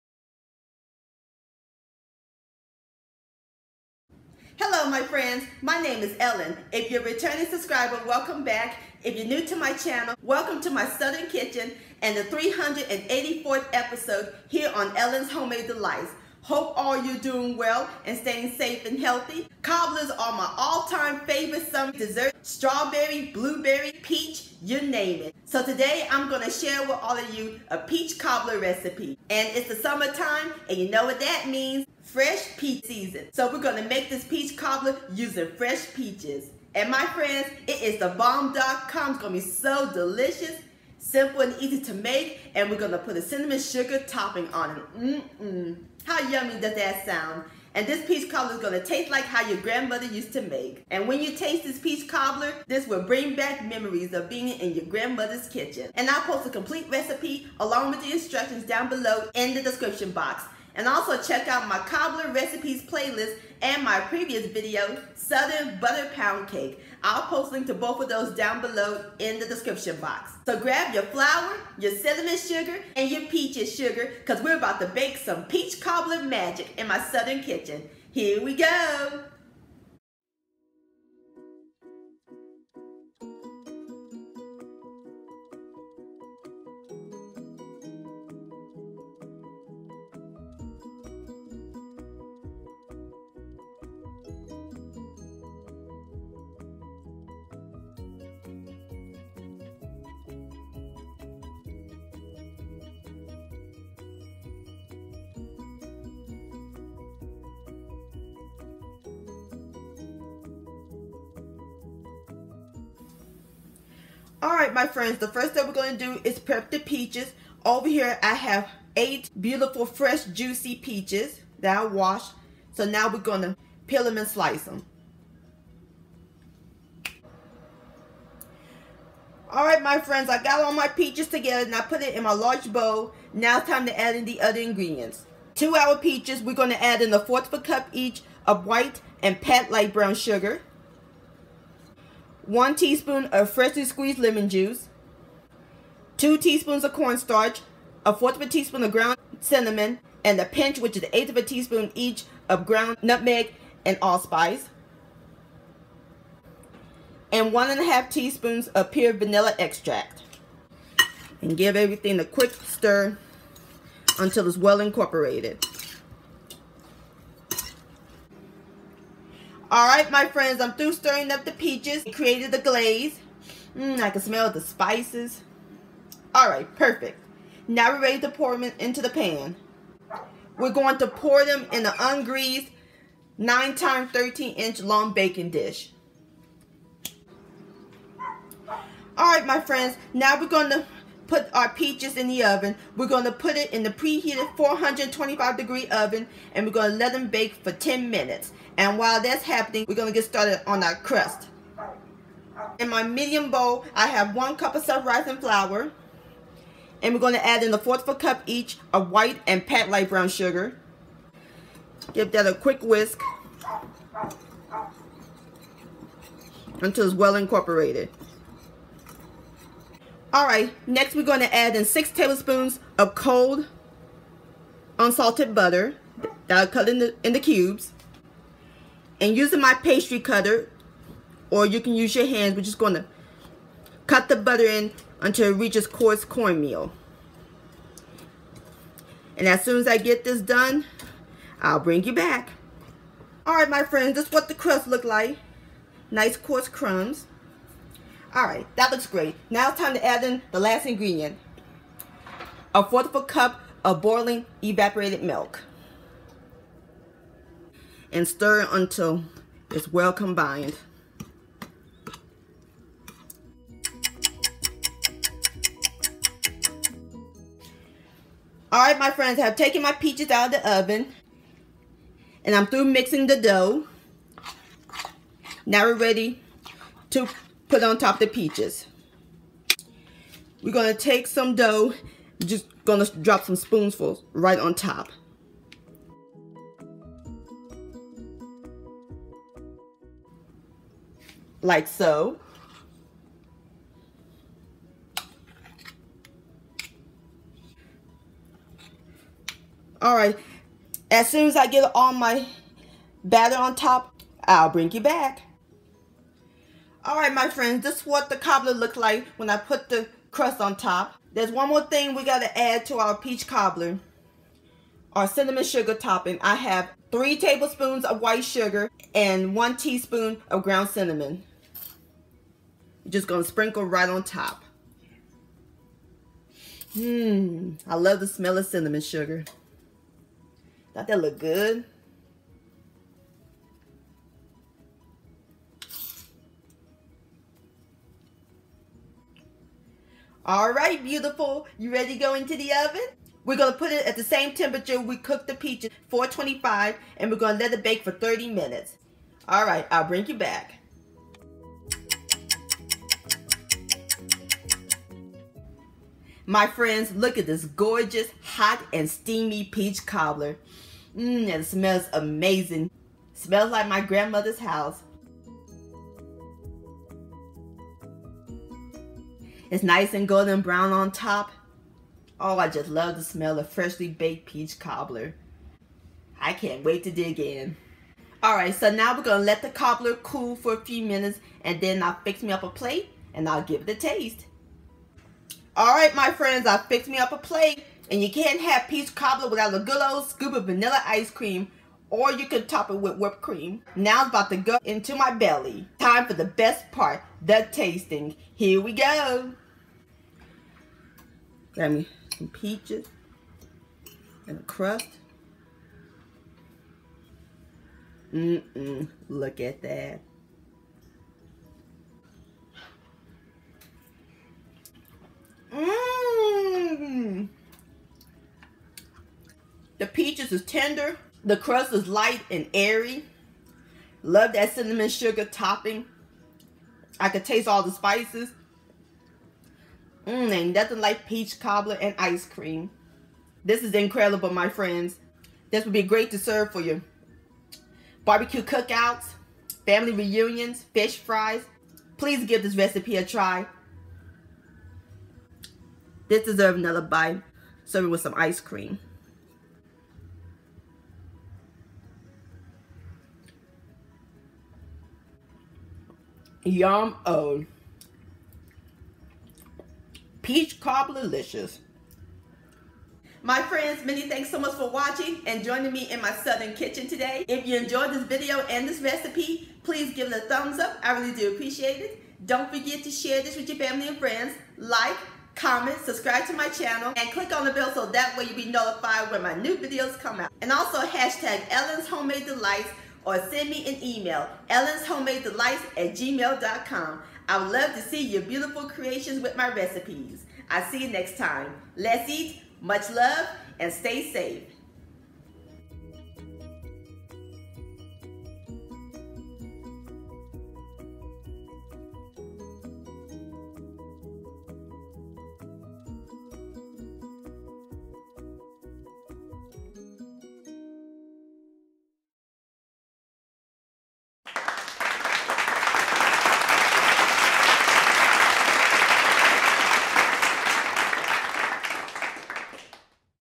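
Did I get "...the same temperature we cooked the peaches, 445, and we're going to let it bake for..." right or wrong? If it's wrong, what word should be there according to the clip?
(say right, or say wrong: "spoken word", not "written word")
wrong: "425", not "445".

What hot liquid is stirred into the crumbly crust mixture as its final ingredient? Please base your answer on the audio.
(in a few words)
boiling evaporated milk.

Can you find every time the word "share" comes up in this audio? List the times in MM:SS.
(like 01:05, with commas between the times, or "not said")
00:26, 07:53.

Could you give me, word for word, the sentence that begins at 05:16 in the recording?
I have three tablespoons of white sugar and one teaspoon of ground cinnamon.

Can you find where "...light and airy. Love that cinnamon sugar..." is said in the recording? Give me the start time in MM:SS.
07:02.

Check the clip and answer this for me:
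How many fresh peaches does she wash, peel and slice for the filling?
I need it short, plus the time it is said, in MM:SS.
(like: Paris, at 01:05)
8, at 01:58.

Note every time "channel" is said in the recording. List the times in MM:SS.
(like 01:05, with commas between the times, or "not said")
00:09, 07:56.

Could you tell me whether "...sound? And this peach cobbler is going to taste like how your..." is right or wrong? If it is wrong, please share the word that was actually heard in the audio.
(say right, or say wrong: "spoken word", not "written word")
right.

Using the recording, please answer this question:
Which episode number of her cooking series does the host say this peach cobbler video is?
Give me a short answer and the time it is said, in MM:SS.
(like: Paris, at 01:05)
384th, at 00:12.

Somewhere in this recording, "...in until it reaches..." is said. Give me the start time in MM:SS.
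03:54.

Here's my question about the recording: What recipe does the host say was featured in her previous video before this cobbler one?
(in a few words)
Southern Butter Pound Cake.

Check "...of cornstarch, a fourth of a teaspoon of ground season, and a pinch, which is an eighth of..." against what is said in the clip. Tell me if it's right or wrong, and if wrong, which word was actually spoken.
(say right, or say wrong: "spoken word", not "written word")
wrong: "cinnamon", not "season".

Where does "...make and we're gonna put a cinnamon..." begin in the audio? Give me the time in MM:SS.
00:41.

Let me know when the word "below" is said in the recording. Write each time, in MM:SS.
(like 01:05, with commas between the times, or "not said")
00:58, 01:08.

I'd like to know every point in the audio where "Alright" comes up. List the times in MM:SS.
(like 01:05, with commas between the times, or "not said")
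01:54, 02:09.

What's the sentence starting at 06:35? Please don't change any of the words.
Time for the best part, the tasting.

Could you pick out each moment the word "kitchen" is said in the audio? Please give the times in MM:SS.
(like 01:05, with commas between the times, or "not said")
00:11, 00:55, 01:17, 07:46.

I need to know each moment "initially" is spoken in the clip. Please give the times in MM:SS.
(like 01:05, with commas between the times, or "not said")
not said.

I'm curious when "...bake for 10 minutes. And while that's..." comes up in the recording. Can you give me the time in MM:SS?
03:17.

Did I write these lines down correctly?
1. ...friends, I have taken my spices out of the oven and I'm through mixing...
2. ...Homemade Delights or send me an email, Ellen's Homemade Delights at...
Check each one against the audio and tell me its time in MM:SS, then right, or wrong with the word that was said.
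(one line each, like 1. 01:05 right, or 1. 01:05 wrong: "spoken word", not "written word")
1. 04:29 wrong: "peaches", not "spices"
2. 08:02 right.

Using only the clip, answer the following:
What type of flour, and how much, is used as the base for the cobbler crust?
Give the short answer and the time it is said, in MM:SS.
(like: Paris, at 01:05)
1 cup self-rising flour, at 03:24.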